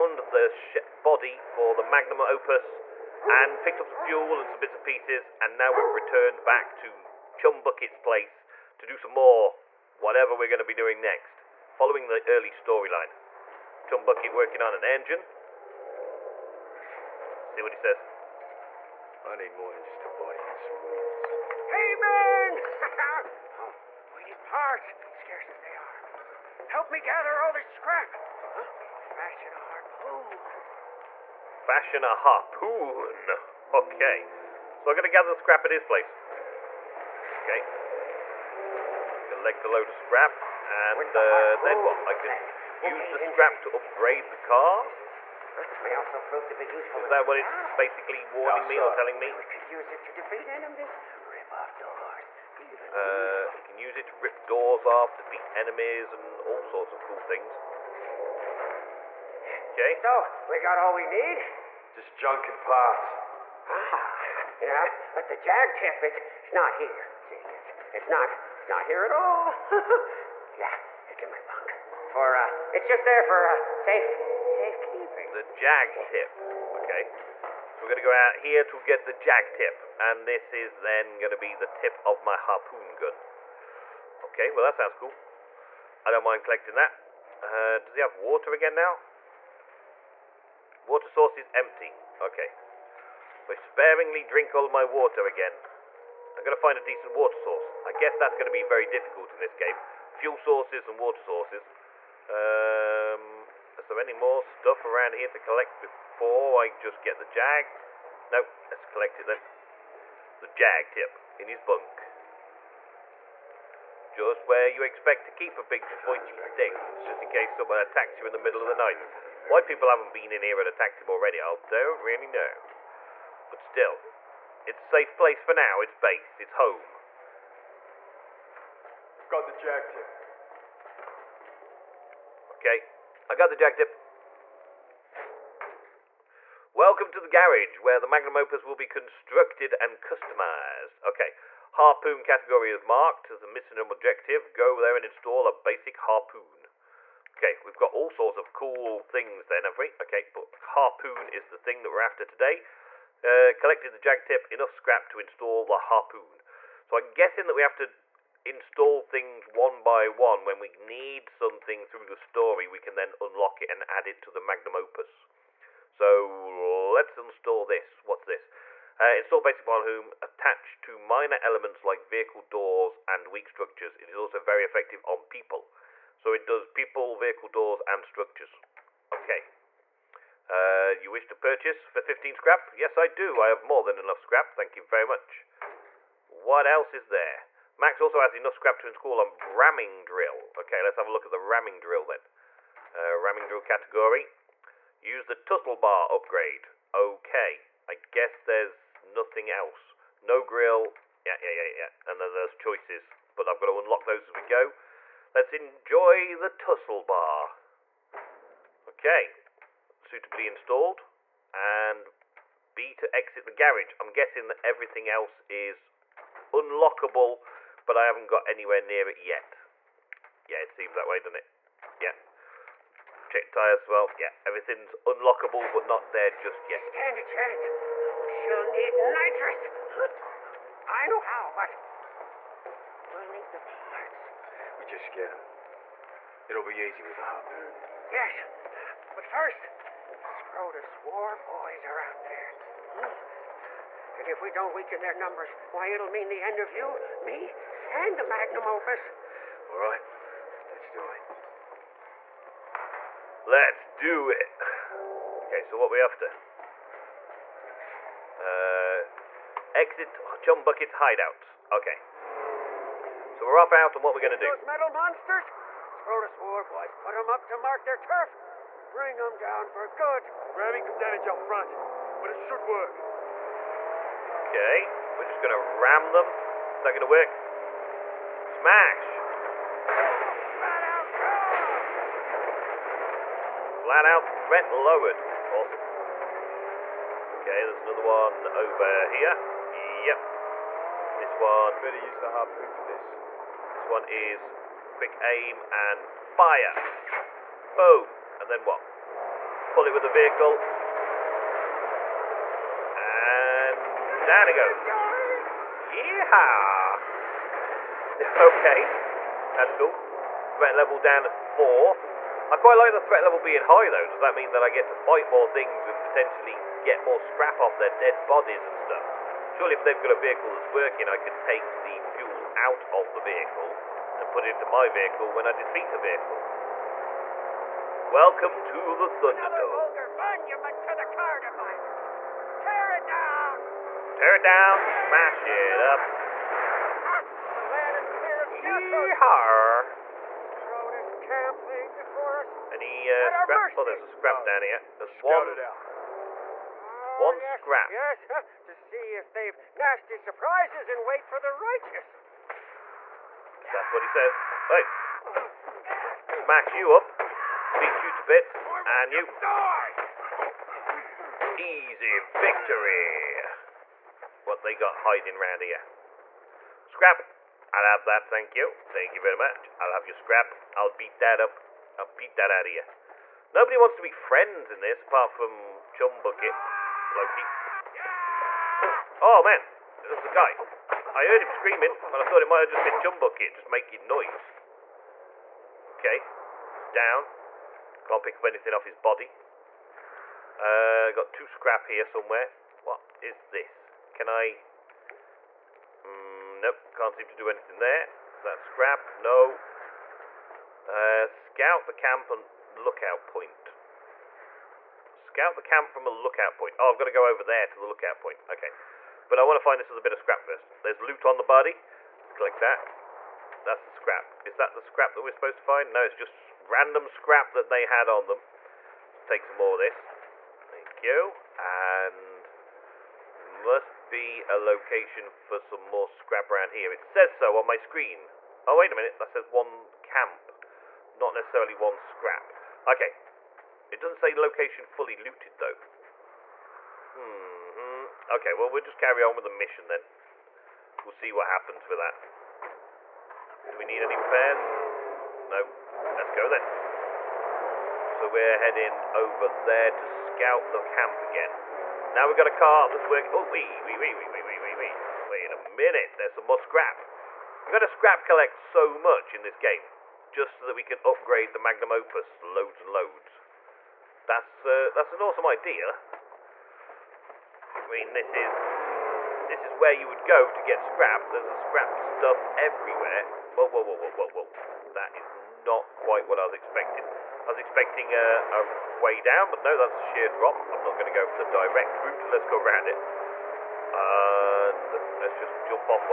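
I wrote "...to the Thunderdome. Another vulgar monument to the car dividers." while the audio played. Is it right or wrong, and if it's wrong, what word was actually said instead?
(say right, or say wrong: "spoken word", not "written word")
right.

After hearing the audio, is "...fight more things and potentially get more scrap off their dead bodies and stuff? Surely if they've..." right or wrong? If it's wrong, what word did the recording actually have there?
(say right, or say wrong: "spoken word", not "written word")
right.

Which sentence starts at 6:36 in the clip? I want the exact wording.
Mm, nope, can't seem to do anything there.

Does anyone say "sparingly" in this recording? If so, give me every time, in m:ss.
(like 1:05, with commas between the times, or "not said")
1:33.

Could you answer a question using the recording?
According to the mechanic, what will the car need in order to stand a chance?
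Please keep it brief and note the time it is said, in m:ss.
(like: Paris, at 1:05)
Nitrous, at 3:48.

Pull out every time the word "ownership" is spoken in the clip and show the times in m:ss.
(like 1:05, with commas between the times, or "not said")
not said.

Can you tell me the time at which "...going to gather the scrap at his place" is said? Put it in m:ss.
0:34.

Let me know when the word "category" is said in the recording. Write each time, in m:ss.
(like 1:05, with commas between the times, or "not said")
2:22, 3:13.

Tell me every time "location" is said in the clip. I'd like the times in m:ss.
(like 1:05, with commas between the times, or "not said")
7:04, 7:14.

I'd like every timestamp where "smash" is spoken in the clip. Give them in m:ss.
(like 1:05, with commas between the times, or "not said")
4:38, 5:35, 5:56.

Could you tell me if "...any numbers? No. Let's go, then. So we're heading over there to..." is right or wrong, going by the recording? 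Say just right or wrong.
wrong.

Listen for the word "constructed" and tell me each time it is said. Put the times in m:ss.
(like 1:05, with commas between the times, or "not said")
2:18.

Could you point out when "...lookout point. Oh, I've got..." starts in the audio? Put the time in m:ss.
6:46.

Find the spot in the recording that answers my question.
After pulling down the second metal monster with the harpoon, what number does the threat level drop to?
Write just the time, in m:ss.
5:11.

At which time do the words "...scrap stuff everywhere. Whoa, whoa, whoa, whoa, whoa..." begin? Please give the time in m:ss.
7:51.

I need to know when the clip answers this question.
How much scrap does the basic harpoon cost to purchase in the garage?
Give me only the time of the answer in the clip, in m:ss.
3:01.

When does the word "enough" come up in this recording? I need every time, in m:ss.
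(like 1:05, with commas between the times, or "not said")
2:34, 3:03, 3:08.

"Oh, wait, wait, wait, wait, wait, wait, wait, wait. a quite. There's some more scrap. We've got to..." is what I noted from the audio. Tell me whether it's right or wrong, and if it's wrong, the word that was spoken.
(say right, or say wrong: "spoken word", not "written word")
wrong: "minute", not "quite".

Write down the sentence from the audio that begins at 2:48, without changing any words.
Uh, install basic Bonhoom attached to minor elements like vehicle doors and weak structures.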